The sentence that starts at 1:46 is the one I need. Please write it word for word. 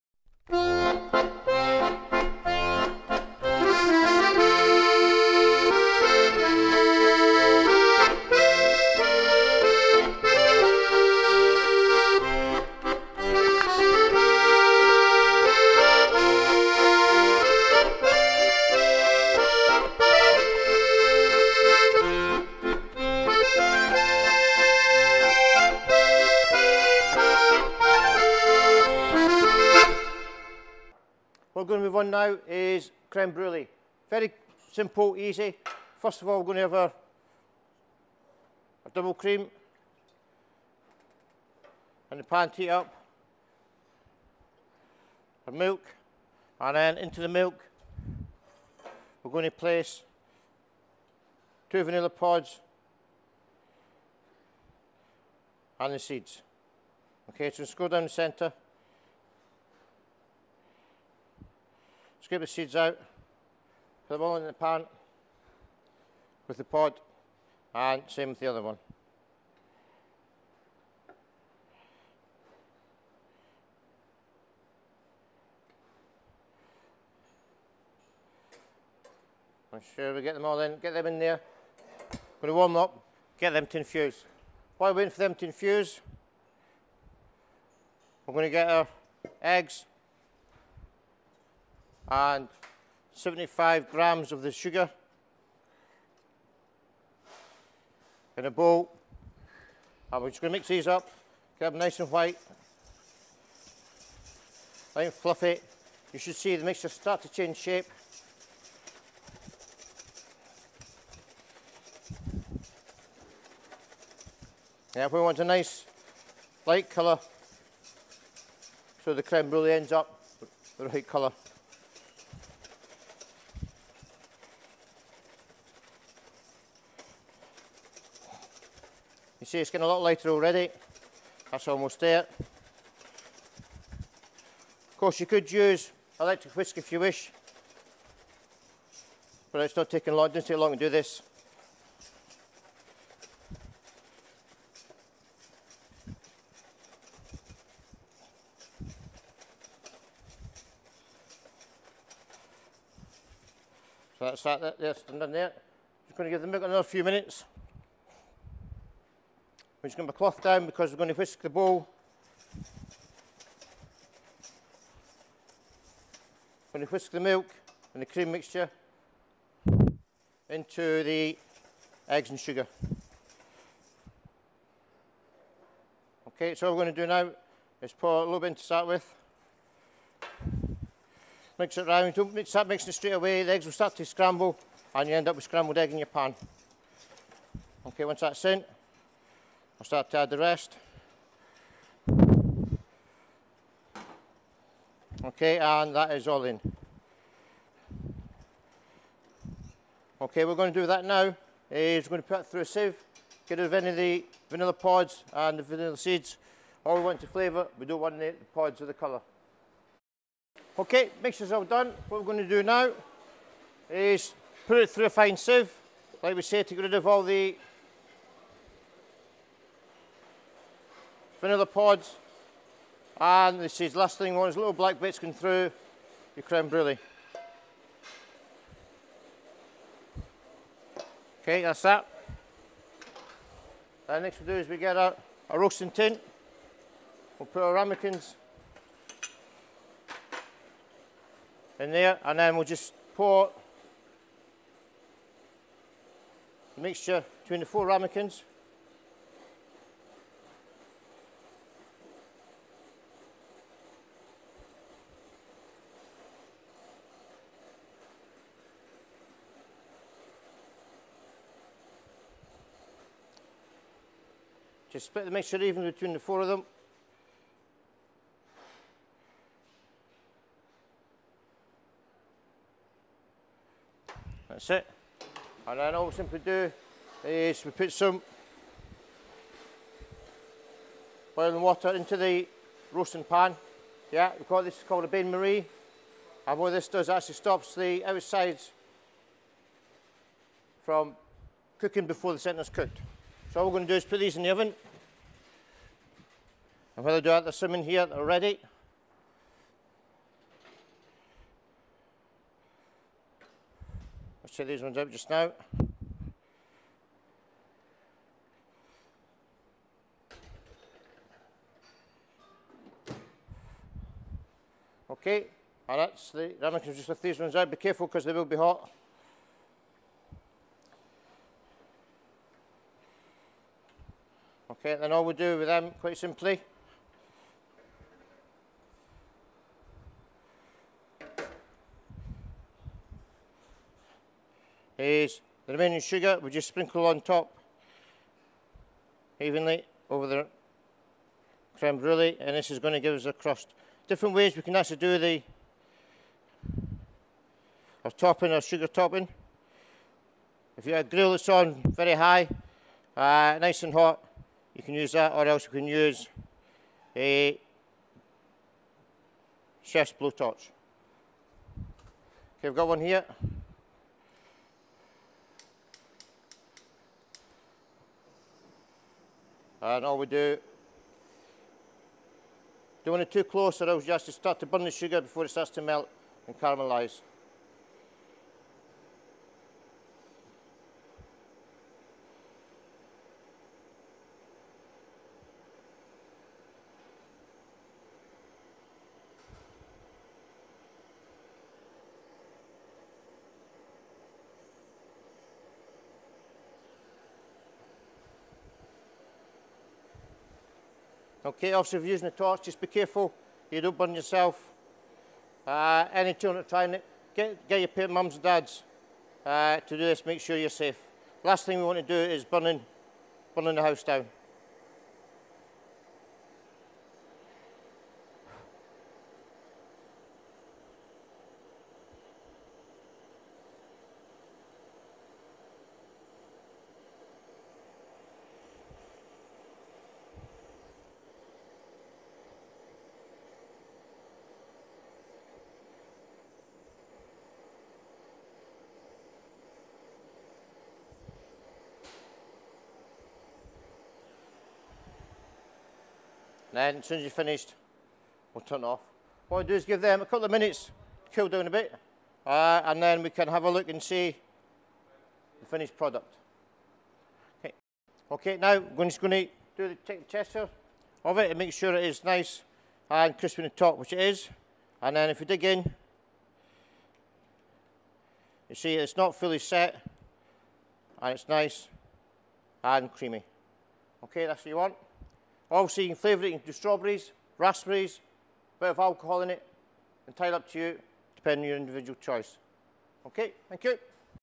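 You should see the mixture start to change shape.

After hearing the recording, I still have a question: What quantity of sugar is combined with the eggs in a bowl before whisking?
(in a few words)
75 grams.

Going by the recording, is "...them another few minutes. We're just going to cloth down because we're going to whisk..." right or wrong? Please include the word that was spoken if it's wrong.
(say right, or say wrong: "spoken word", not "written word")
right.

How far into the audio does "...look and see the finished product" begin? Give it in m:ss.
7:33.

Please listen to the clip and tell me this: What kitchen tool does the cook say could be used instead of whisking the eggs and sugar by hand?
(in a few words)
Electric whisk.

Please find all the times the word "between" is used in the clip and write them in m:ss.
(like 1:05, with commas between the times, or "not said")
4:07, 4:25.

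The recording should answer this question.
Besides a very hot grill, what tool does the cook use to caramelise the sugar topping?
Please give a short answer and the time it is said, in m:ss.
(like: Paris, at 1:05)
Chef's blowtorch, at 5:59.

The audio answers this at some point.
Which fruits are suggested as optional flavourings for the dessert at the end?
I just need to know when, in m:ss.
7:56.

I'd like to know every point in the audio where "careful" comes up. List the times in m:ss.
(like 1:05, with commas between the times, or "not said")
5:17, 6:42.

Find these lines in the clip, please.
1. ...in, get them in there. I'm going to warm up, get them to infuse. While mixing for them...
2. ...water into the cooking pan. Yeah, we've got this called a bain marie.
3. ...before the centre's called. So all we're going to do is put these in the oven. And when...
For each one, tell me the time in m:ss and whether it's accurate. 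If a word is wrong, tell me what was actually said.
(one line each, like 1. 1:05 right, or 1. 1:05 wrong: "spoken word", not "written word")
1. 1:20 wrong: "waiting", not "mixing"
2. 4:41 wrong: "roasting", not "cooking"
3. 4:52 wrong: "cooked", not "called".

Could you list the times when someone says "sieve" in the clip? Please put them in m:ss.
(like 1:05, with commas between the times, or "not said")
3:22, 3:35.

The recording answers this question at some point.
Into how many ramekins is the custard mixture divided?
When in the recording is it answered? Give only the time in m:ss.
4:07.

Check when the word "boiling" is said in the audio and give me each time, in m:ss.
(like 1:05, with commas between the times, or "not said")
4:41.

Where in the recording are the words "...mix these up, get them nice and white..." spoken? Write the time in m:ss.
1:40.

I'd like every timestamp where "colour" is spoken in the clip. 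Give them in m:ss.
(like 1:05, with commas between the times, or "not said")
1:56, 2:01, 3:28.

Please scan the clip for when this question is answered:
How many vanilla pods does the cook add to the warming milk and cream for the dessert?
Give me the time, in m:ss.
0:51.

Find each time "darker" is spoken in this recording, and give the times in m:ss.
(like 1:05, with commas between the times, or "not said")
not said.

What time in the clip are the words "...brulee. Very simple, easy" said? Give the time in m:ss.
0:33.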